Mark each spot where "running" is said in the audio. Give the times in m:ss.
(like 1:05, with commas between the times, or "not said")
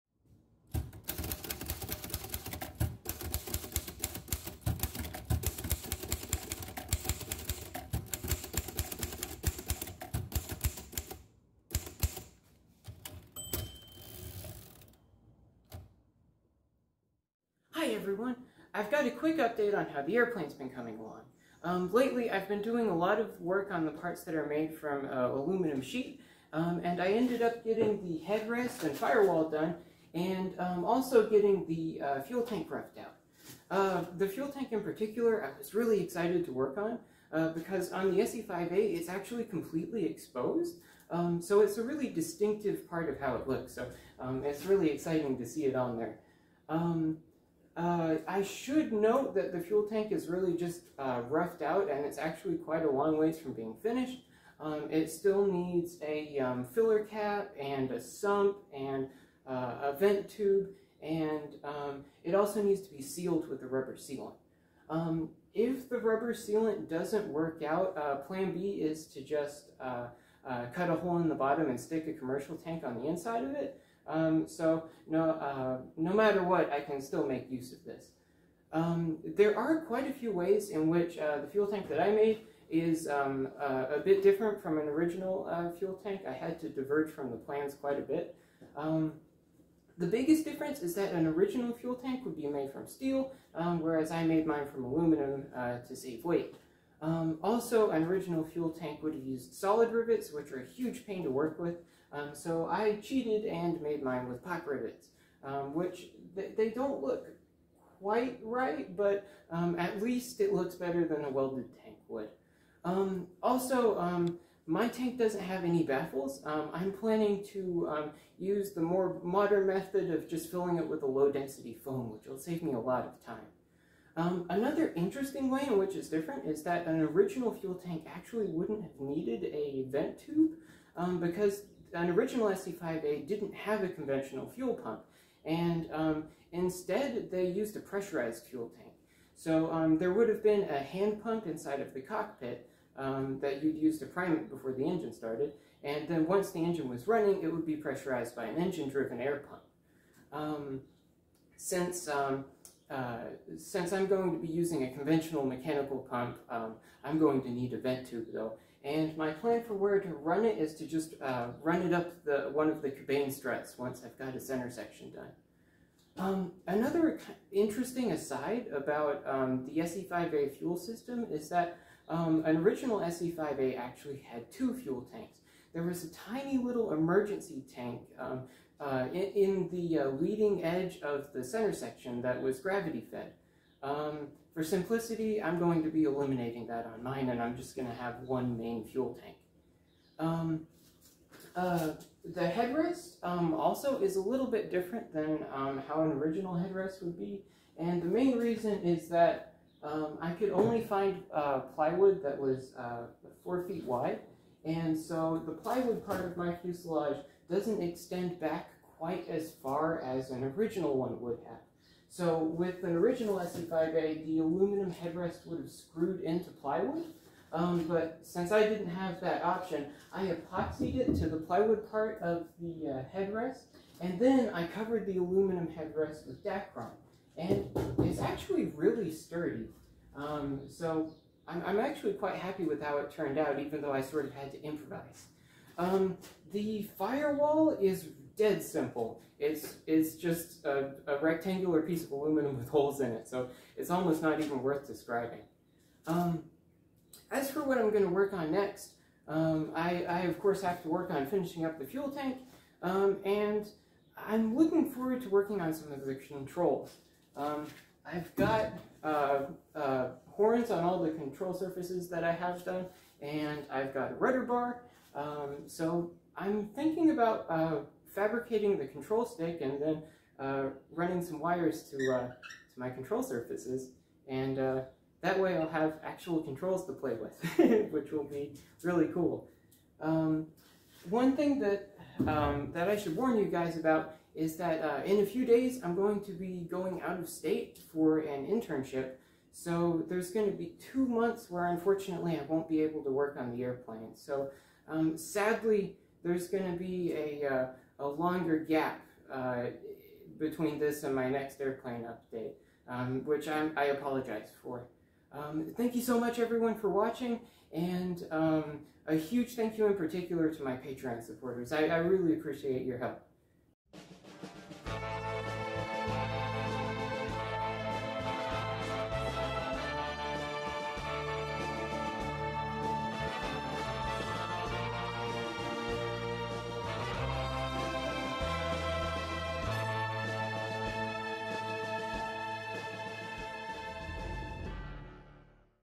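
2:27, 4:30.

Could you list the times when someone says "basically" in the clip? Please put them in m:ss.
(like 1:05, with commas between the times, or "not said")
not said.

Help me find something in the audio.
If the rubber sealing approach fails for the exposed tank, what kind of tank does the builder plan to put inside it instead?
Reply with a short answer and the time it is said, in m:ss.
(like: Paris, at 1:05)
commercial tank, at 1:12.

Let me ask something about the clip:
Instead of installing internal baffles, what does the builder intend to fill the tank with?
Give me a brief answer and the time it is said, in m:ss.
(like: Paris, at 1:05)
low density foam, at 2:01.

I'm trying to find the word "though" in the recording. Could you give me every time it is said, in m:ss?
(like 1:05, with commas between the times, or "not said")
2:38, 3:53.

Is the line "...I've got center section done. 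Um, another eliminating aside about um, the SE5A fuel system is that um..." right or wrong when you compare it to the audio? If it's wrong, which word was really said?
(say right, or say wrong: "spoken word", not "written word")
wrong: "interesting", not "eliminating".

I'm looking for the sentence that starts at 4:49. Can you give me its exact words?
So there's going to be two months where unfortunately I won't be able to work on the airplane.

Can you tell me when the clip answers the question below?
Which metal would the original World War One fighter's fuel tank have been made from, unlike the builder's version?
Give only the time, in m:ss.
1:32.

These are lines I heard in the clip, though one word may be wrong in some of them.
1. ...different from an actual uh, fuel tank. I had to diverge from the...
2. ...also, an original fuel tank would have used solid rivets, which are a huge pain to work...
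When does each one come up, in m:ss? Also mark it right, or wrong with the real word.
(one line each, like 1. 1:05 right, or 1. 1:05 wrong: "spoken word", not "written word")
1. 1:24 wrong: "original", not "actual"
2. 1:37 right.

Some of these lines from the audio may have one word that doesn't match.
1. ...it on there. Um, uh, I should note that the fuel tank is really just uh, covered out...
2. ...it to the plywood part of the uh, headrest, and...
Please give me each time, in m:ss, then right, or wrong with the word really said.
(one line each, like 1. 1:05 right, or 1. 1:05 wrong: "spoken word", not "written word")
1. 0:45 wrong: "roughed", not "covered"
2. 3:40 right.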